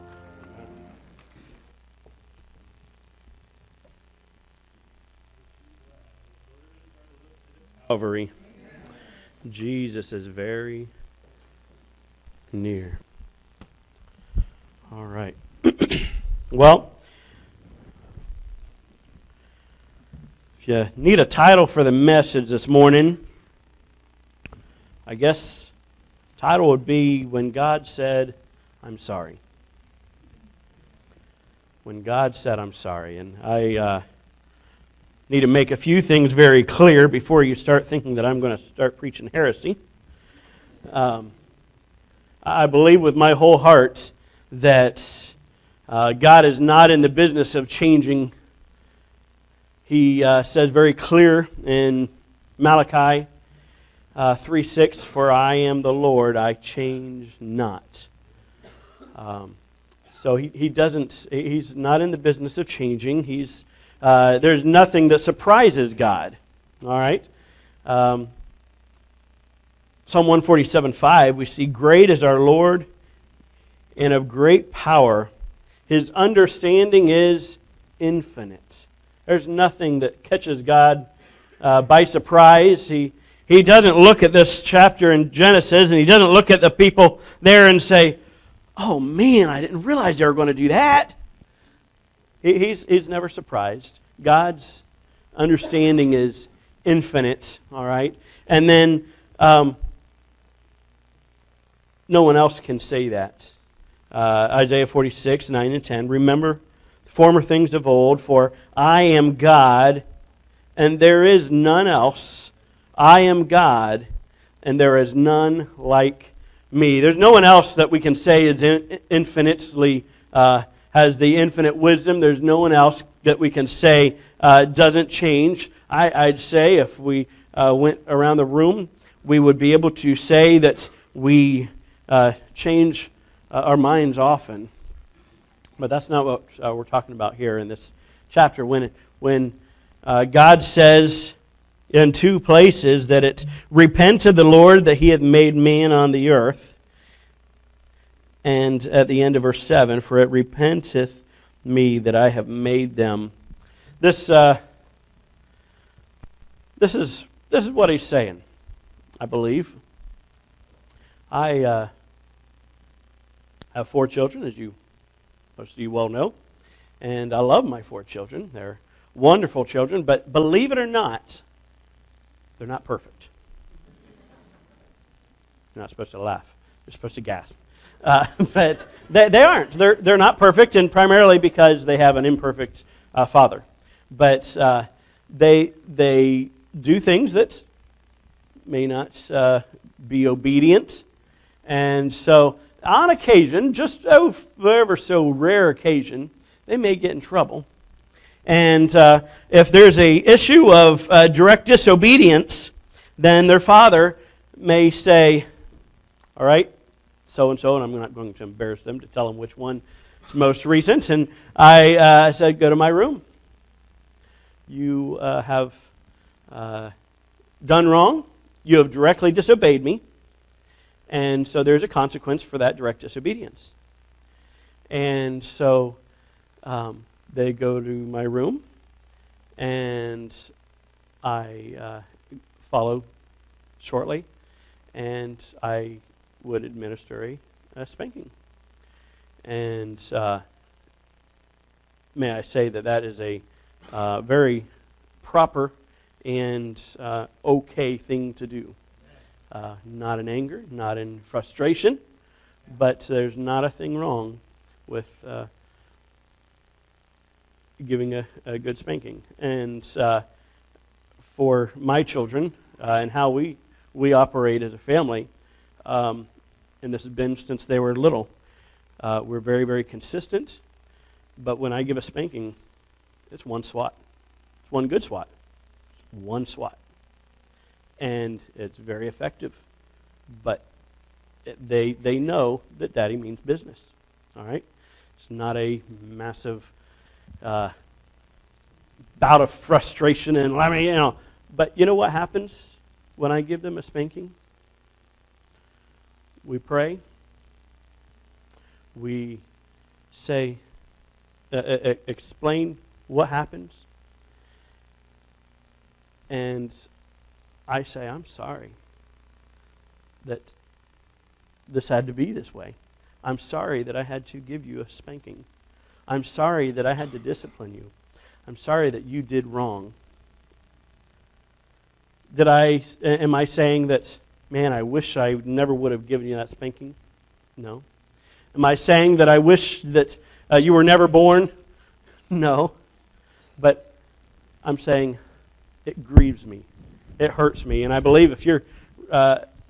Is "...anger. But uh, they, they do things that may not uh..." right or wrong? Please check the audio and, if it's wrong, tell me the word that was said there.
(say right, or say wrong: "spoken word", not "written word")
wrong: "father", not "anger".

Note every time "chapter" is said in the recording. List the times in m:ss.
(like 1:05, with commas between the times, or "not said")
1:24, 2:18.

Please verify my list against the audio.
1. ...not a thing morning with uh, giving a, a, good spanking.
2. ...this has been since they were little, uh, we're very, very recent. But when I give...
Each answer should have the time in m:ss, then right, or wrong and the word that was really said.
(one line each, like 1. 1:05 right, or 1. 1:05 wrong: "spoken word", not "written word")
1. 4:13 wrong: "wrong", not "morning"
2. 4:26 wrong: "consistent", not "recent".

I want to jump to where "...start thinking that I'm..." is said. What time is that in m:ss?
0:37.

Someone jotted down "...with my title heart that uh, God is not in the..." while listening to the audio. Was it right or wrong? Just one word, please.
wrong.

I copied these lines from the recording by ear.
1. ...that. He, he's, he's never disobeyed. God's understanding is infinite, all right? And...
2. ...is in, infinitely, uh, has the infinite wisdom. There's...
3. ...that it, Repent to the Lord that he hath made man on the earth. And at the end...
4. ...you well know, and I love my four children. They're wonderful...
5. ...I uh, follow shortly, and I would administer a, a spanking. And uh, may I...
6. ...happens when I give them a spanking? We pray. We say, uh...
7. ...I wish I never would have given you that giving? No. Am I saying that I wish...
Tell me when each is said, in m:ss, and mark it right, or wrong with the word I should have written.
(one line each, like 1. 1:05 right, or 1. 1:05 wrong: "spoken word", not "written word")
1. 1:30 wrong: "surprised", not "disobeyed"
2. 1:58 right
3. 2:23 right
4. 2:45 right
5. 3:51 right
6. 4:52 right
7. 5:24 wrong: "spanking", not "giving".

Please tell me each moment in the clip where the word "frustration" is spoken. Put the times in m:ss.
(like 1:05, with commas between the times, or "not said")
4:11, 4:49.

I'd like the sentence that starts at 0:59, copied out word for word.
Um, so he, he doesn't, he's not in the business of changing.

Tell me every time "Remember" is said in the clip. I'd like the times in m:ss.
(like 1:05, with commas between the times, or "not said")
1:46.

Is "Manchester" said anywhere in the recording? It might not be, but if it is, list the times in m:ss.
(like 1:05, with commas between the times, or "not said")
not said.